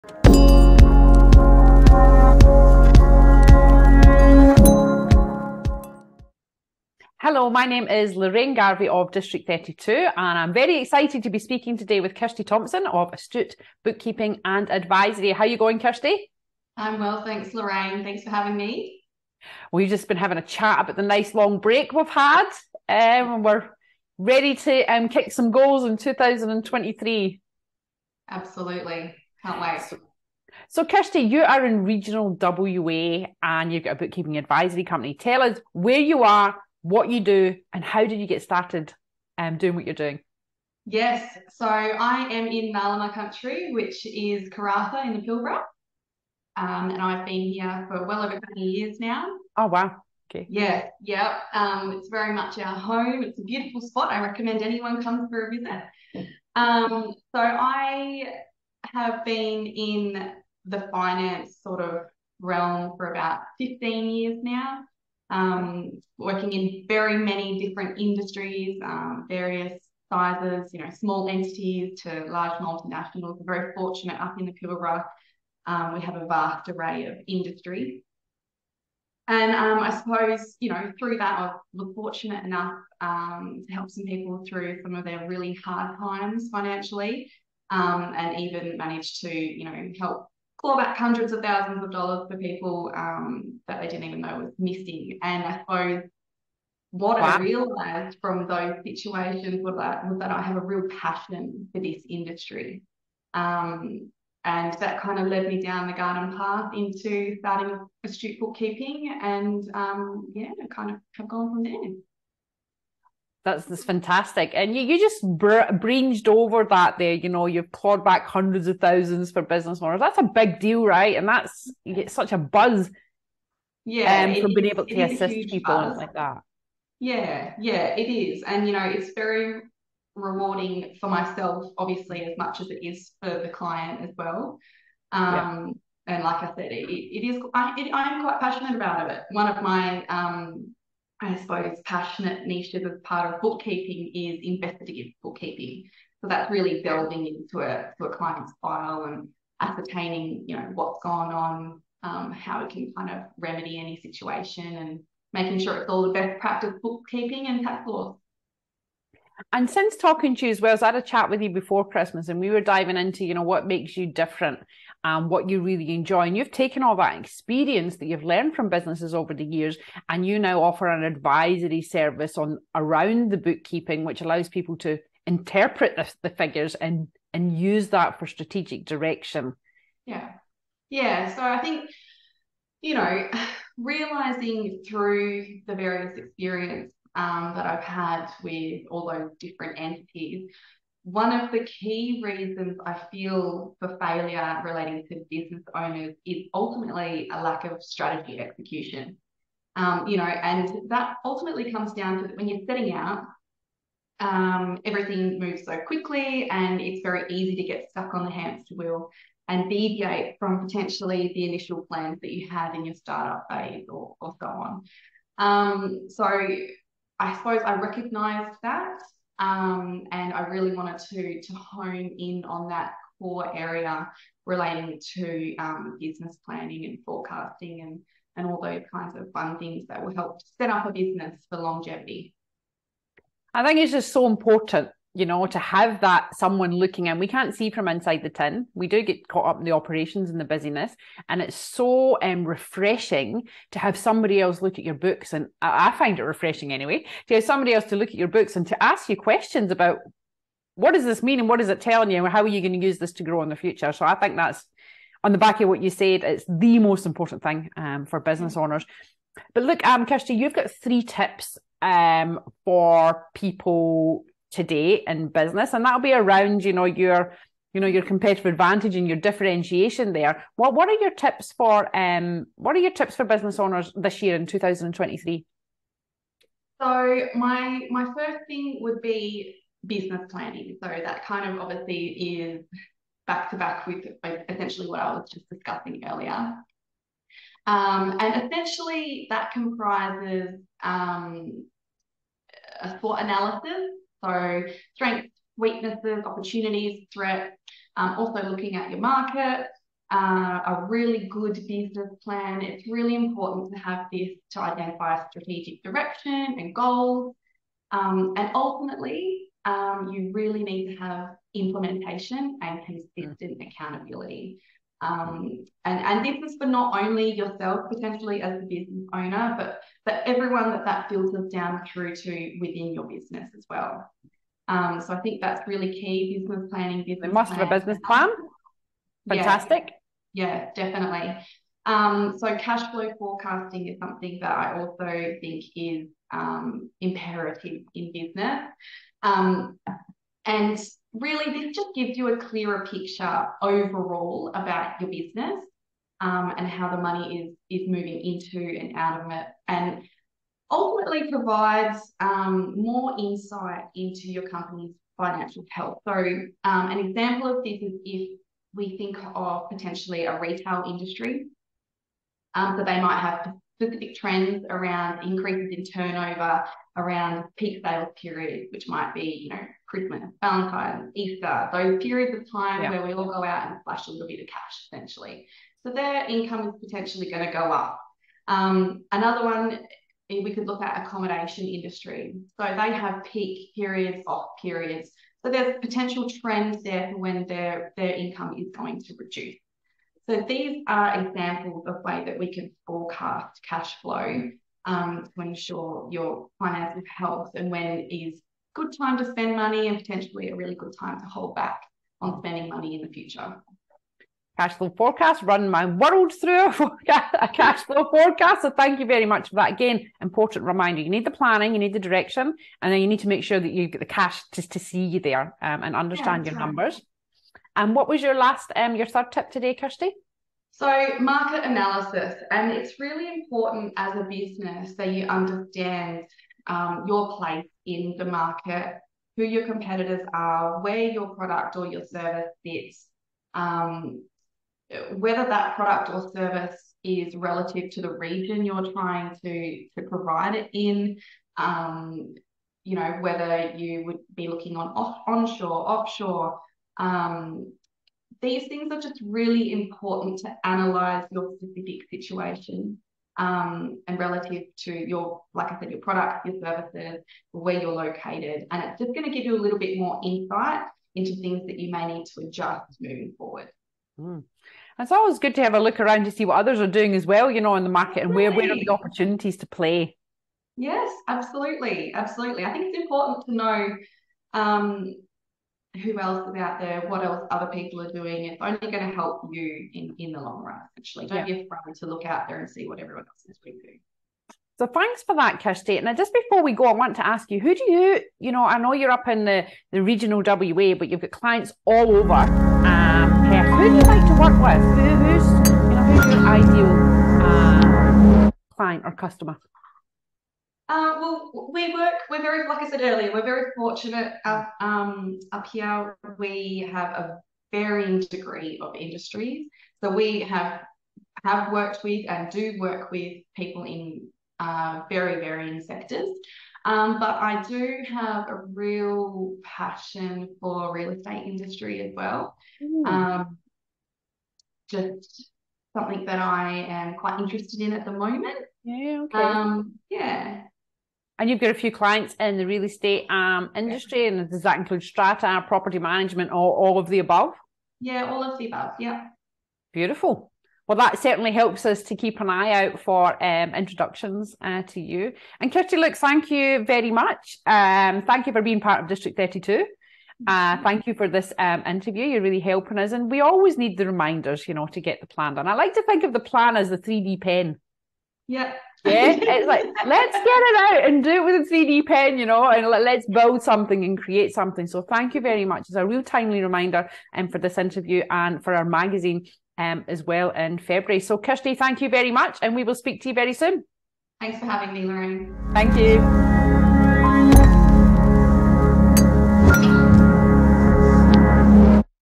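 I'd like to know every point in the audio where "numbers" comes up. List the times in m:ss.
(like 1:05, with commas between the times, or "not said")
6:56.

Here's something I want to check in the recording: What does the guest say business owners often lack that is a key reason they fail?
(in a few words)
Strategy execution.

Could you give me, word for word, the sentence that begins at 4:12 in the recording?
And how are you going to use this to grow in the future?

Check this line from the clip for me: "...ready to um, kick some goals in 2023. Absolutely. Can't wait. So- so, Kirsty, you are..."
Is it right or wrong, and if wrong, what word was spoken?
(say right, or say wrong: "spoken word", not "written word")
right.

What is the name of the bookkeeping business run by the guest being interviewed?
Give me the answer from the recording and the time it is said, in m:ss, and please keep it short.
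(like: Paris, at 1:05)
Astute Bookkeeping and Advisory, at 0:13.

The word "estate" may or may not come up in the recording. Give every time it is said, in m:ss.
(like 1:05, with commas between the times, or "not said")
8:41, 8:52.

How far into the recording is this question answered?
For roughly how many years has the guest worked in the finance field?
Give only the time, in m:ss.
1:03.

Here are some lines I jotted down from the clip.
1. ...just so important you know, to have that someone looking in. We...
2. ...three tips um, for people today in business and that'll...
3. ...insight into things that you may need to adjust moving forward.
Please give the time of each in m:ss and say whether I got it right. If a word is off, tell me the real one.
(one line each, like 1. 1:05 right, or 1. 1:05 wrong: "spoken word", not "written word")
1. 3:53 right
2. 4:20 right
3. 7:40 right.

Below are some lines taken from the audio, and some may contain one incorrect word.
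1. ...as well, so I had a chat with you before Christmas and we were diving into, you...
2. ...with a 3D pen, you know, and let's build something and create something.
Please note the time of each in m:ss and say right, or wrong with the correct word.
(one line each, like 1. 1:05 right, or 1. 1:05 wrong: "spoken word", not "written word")
1. 2:40 right
2. 9:21 right.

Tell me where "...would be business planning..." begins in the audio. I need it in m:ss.
4:38.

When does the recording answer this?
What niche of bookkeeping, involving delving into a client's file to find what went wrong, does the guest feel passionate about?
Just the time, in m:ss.
2:24.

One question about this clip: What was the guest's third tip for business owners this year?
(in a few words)
Market analysis.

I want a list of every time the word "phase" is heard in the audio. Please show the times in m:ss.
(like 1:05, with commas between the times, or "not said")
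3:33.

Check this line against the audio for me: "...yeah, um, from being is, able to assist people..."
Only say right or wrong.
right.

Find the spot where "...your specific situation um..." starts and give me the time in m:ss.
7:31.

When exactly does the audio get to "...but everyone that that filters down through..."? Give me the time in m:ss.
5:20.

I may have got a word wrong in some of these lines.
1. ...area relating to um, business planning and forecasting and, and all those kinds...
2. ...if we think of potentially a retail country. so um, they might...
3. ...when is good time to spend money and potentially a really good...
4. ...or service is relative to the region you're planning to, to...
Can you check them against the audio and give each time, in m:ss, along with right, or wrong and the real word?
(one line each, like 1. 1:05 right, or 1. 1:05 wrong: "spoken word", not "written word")
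1. 3:43 right
2. 5:58 wrong: "industry", not "country"
3. 6:37 right
4. 7:16 wrong: "trying", not "planning".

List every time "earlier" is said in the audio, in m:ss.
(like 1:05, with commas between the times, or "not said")
4:46, 8:22.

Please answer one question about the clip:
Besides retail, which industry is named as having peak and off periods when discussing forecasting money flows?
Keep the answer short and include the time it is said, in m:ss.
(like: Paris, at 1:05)
Accommodation, at 6:21.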